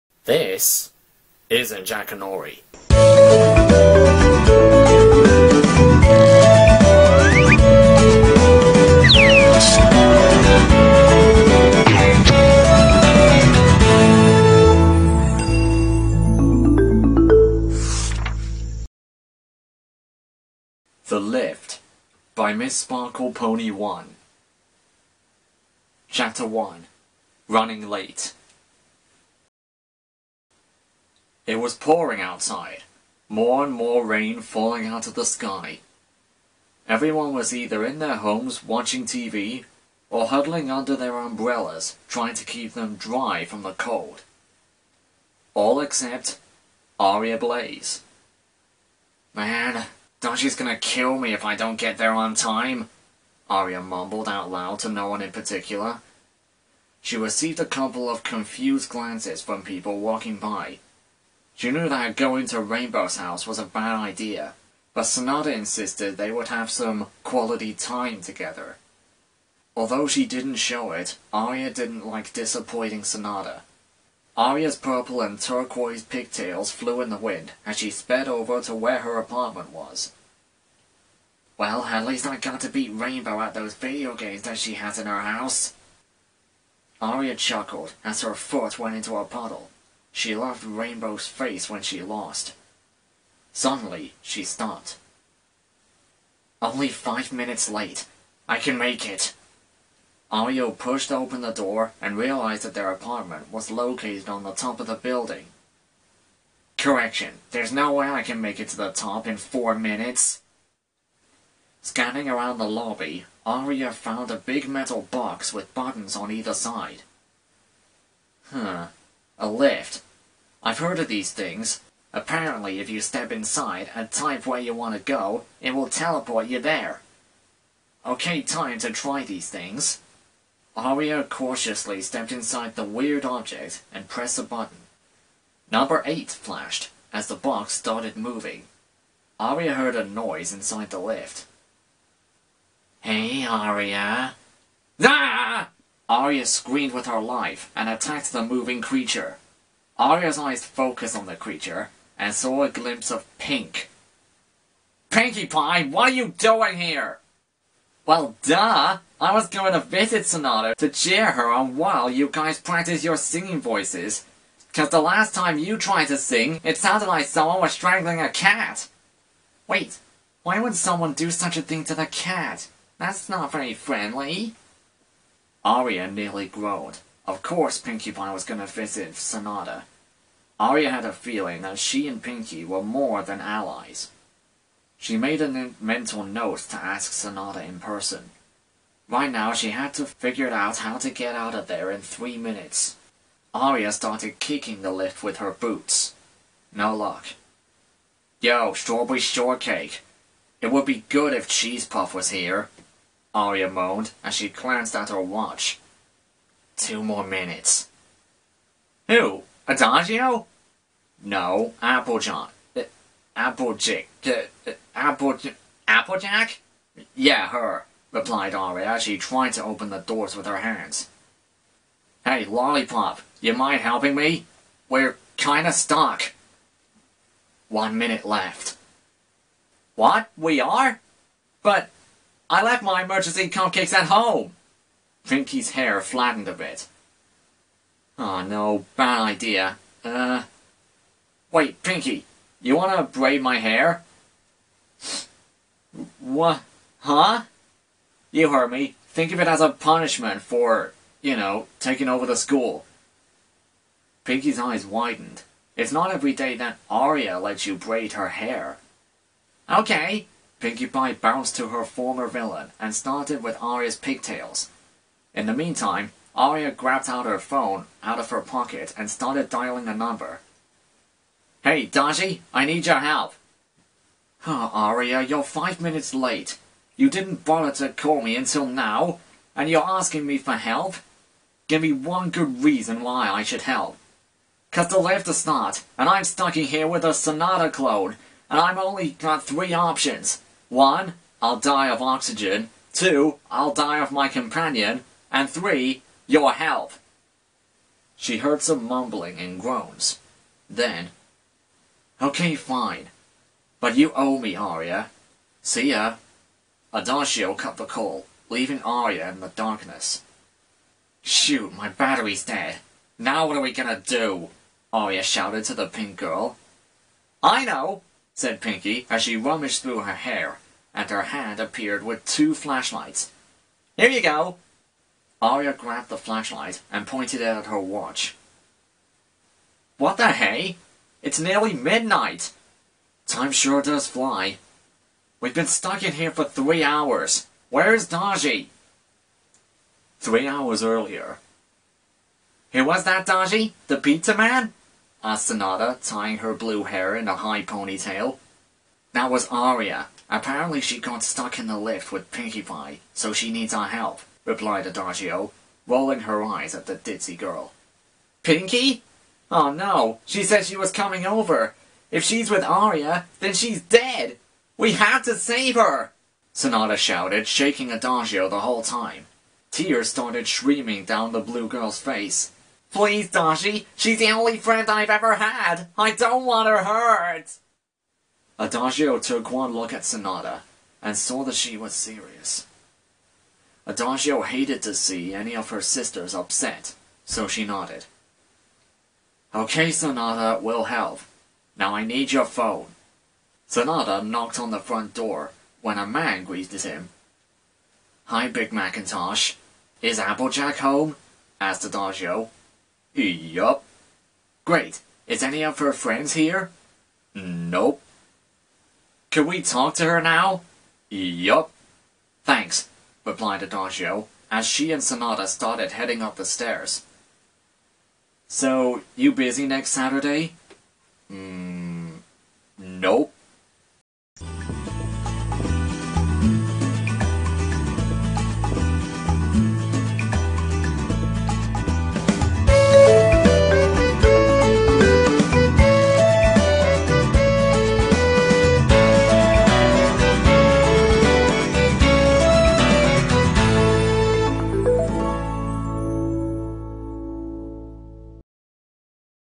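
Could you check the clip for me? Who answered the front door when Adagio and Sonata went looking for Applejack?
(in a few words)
Big McIntosh.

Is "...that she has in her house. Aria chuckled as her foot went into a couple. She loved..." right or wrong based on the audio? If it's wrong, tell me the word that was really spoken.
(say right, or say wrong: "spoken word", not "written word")
wrong: "puddle", not "couple".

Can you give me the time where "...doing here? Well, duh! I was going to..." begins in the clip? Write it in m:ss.
2:36.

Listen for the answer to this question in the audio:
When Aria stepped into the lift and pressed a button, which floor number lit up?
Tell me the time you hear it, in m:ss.
2:15.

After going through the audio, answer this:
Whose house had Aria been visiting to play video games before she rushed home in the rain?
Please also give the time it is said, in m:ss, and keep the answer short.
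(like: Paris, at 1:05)
Rainbow's house, at 1:02.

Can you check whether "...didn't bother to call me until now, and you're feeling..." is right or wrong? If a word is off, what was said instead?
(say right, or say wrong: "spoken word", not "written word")
wrong: "asking", not "feeling".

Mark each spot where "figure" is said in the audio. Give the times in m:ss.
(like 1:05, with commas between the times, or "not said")
3:10.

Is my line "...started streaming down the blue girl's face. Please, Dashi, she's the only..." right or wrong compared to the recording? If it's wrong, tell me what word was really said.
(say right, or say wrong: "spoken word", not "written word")
right.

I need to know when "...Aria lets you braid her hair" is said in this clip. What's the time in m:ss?
4:16.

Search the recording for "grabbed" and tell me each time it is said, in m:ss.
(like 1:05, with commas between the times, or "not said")
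4:26, 5:25.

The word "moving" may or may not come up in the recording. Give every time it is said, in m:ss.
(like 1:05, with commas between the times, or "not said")
2:18, 2:28.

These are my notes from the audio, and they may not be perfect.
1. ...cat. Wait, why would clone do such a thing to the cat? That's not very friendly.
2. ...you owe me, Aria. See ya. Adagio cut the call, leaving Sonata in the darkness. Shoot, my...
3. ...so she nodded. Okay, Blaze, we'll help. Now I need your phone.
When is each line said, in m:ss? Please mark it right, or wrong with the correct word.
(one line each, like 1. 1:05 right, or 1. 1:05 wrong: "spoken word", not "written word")
1. 2:48 wrong: "someone", not "clone"
2. 5:03 wrong: "Aria", not "Sonata"
3. 6:27 wrong: "Sonata", not "Blaze".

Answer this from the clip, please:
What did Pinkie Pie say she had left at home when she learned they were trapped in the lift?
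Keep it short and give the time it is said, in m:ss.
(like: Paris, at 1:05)
emergency cupcakes, at 3:53.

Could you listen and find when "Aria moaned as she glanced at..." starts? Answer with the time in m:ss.
3:23.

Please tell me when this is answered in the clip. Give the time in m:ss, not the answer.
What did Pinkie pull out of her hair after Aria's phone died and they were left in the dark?
5:22.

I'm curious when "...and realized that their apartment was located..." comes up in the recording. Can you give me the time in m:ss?
1:42.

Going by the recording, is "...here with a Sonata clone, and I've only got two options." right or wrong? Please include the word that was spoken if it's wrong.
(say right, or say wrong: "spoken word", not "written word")
wrong: "three", not "two".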